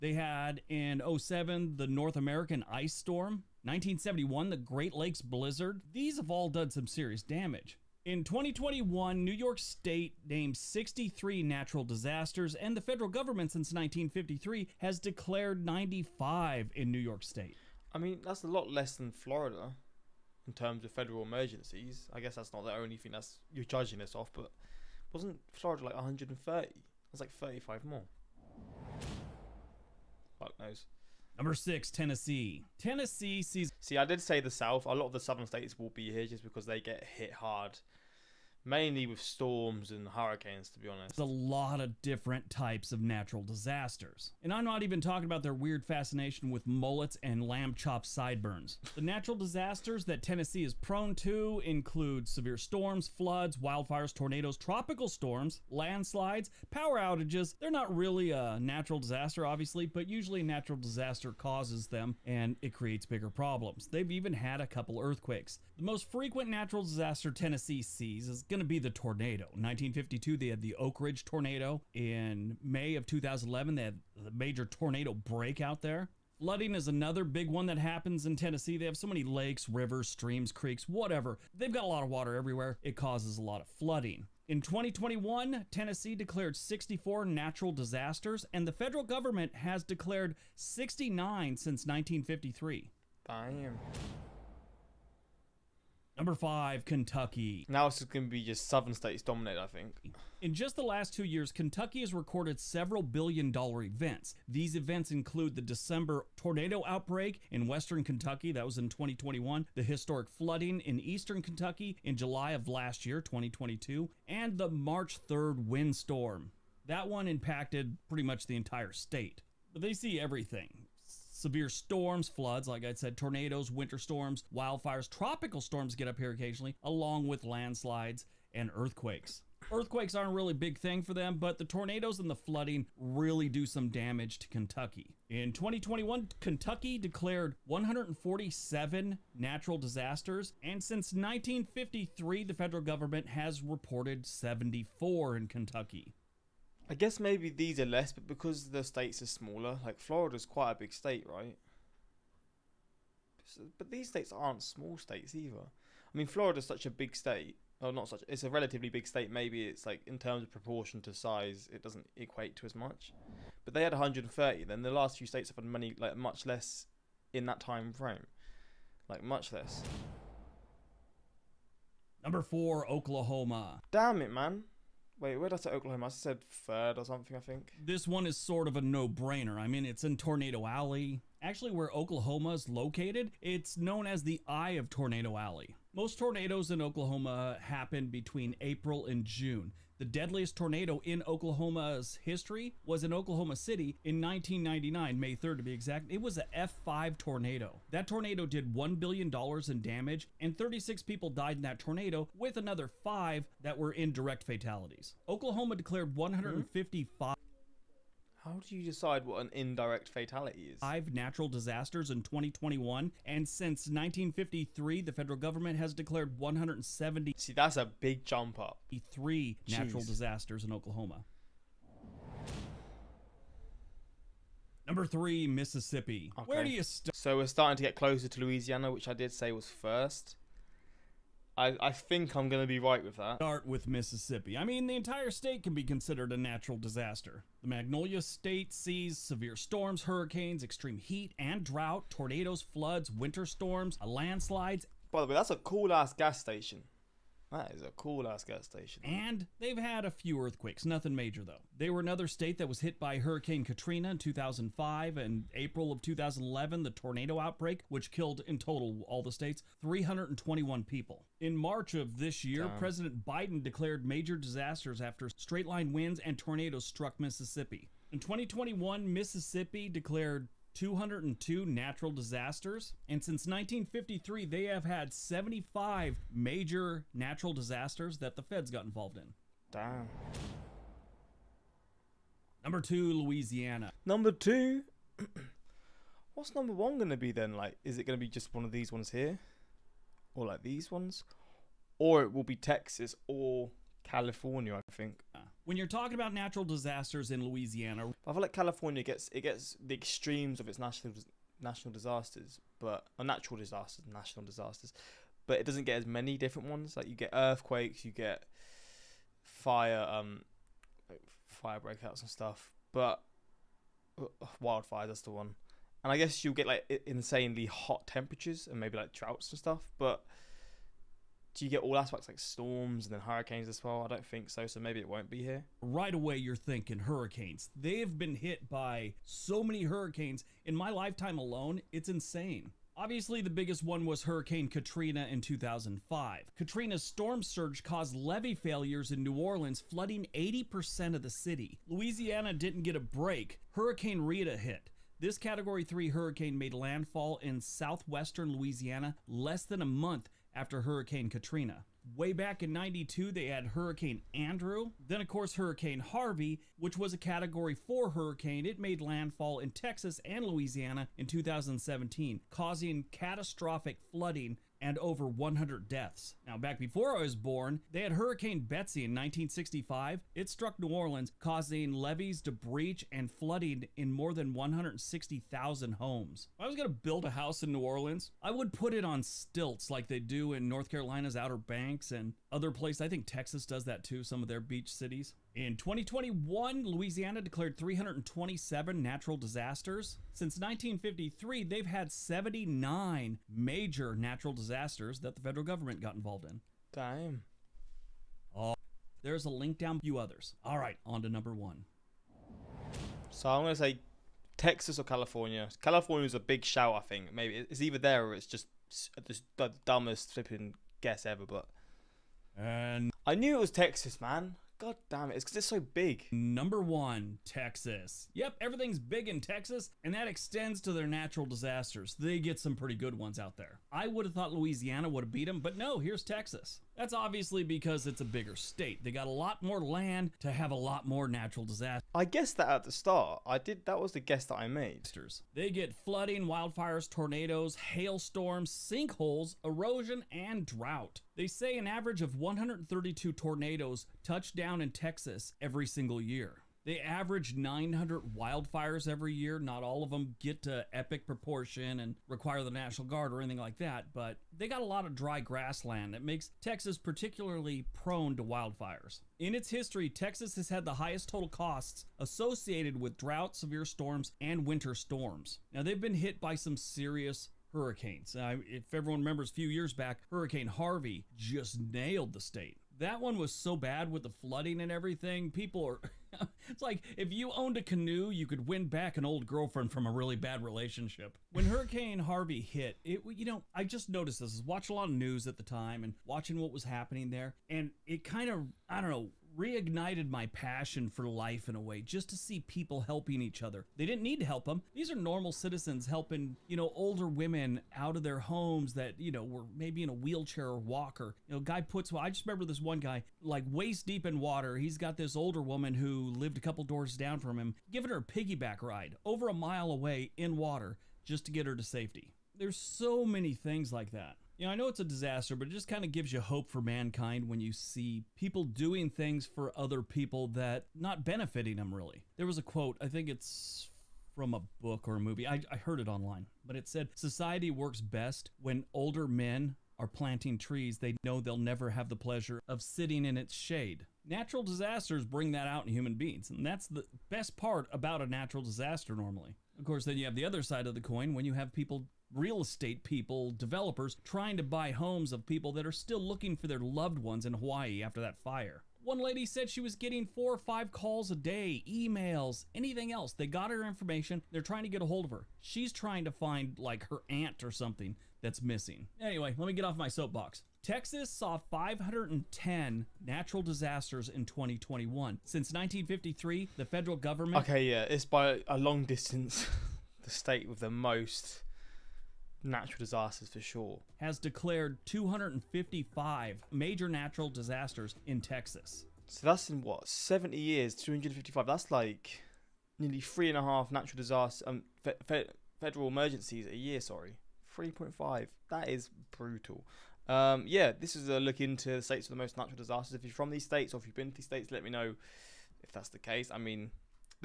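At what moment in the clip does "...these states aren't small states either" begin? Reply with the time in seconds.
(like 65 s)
153 s.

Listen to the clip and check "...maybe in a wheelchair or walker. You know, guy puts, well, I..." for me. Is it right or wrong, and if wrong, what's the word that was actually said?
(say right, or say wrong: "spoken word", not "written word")
right.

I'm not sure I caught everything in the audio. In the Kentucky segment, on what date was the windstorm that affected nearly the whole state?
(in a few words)
March 3rd.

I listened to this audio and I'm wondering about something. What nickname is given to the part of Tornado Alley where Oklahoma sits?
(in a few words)
Eye of Tornado Alley.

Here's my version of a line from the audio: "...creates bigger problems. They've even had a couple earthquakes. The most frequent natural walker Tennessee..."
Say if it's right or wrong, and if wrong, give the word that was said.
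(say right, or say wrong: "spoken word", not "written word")
wrong: "disaster", not "walker".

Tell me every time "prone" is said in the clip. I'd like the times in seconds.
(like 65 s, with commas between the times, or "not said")
50 s, 457 s.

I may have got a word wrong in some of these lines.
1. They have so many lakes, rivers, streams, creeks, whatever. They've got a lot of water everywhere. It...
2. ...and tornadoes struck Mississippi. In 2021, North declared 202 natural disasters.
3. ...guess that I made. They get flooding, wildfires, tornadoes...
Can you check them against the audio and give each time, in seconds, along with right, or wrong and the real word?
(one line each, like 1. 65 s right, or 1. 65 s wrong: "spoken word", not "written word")
1. 78 s right
2. 266 s wrong: "Mississippi", not "North"
3. 434 s right.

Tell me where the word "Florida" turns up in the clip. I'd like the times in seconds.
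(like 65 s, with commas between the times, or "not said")
19 s, 25 s, 149 s, 156 s.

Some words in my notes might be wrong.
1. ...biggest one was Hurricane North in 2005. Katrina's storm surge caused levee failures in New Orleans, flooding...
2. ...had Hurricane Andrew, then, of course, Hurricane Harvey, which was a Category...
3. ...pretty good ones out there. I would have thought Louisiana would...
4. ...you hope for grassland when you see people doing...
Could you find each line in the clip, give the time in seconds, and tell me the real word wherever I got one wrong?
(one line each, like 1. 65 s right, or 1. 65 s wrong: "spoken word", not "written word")
1. 333 s wrong: "Katrina", not "North"
2. 353 s right
3. 422 s right
4. 516 s wrong: "mankind", not "grassland".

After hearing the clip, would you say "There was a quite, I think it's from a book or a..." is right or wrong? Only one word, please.
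wrong.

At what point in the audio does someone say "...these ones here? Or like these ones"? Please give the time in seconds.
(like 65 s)
288 s.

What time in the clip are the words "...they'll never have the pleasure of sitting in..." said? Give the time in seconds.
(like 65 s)
531 s.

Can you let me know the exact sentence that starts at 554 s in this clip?
They're trying to get a hold of her.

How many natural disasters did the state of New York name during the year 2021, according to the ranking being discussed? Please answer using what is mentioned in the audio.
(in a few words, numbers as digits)
63.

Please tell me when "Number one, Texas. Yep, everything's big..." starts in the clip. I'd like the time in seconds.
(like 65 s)
416 s.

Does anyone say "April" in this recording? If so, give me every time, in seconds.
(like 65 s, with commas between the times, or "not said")
188 s, 255 s.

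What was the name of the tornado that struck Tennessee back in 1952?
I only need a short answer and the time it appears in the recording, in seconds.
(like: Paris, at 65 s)
Oak Ridge tornado, at 70 s.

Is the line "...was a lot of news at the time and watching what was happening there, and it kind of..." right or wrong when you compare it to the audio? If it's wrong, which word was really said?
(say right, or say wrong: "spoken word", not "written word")
right.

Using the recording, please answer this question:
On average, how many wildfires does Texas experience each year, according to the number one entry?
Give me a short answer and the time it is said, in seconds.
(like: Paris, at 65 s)
900, at 447 s.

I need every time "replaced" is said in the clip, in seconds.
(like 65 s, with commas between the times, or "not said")
not said.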